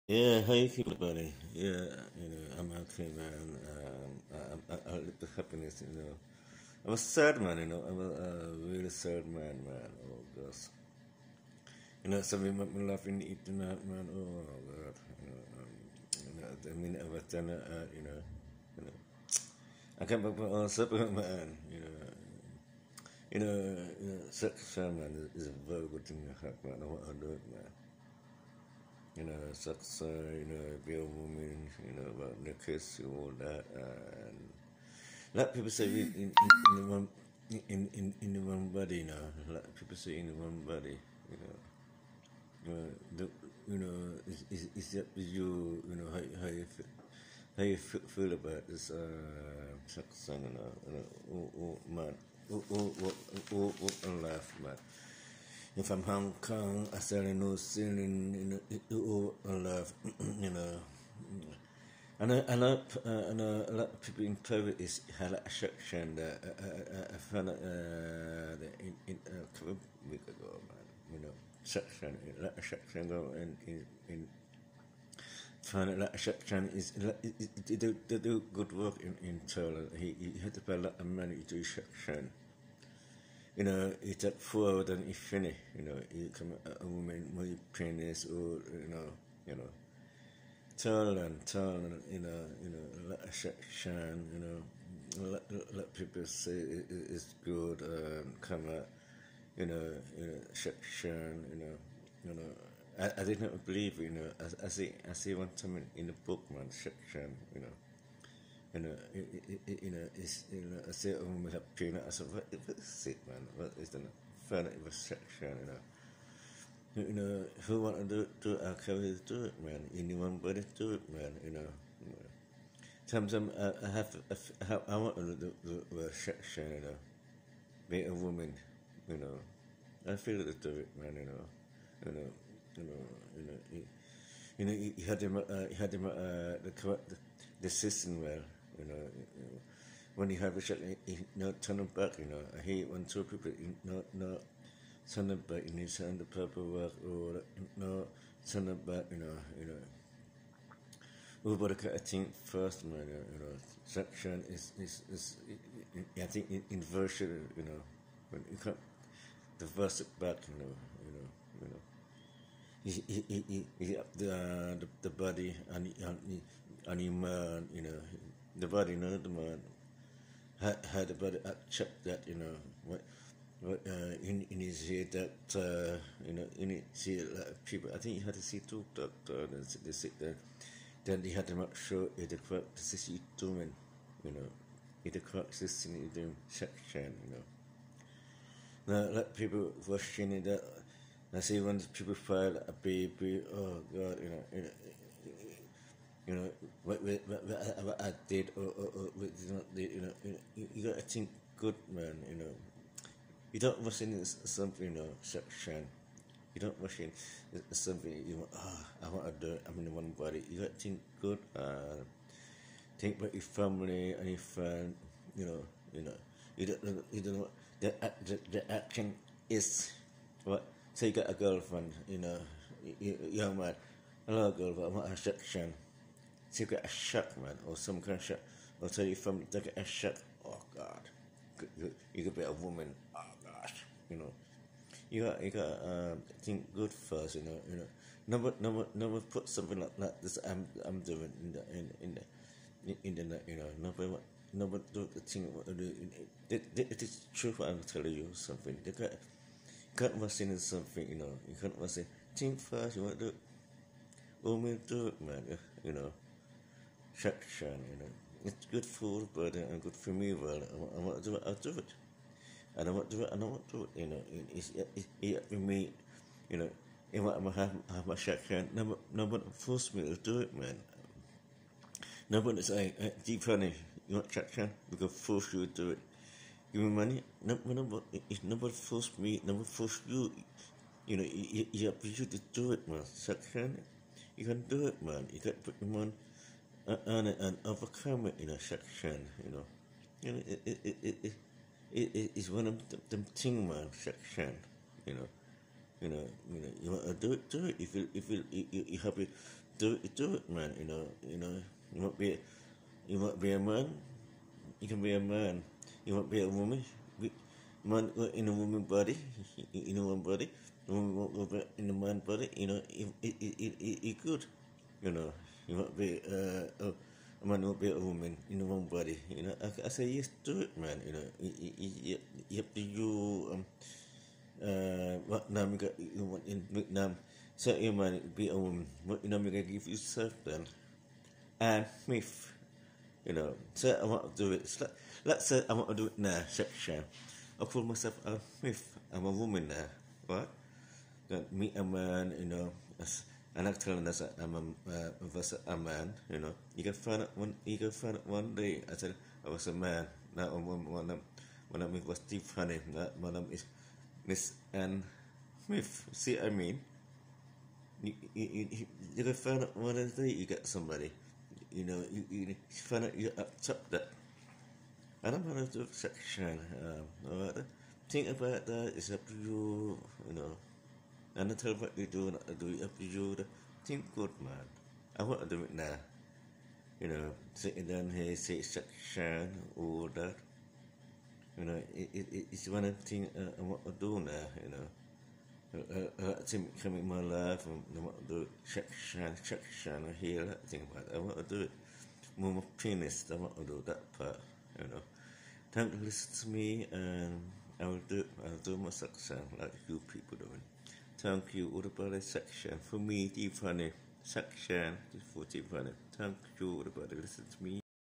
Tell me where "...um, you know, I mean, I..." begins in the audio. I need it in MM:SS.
00:15.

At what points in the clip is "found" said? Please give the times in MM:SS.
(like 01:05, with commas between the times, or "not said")
01:07, 01:15.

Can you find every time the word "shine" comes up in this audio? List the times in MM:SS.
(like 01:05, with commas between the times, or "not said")
01:33, 01:40, 01:46.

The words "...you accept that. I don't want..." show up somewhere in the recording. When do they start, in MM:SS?
06:03.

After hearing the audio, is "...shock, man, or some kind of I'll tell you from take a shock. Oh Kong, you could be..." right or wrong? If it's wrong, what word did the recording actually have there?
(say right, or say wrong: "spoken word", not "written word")
wrong: "God", not "Kong".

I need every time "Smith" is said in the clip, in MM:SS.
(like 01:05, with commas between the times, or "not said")
05:55.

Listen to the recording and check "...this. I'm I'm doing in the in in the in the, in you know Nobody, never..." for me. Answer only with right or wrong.
right.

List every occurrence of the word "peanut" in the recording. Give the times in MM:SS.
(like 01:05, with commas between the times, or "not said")
01:51.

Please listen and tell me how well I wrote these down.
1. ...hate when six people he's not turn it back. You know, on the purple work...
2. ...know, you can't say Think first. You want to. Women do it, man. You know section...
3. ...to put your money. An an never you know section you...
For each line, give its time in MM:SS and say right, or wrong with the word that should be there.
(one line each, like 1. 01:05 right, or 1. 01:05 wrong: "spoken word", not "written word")
1. 02:22 wrong: "two", not "six"
2. 04:11 right
3. 04:45 wrong: "overcomer", not "never".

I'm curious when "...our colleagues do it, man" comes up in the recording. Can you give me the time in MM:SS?
01:58.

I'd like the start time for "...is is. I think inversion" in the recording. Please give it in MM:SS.
02:34.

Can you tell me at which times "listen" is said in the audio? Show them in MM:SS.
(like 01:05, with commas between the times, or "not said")
06:36, 06:47.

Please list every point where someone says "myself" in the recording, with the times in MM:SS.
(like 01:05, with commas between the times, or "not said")
05:37.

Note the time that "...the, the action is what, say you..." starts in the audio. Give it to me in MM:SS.
03:38.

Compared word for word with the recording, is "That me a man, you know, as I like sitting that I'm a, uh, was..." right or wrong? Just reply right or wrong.
wrong.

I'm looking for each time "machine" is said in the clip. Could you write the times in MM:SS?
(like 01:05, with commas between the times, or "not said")
04:10.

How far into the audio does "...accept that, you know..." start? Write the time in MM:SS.
02:51.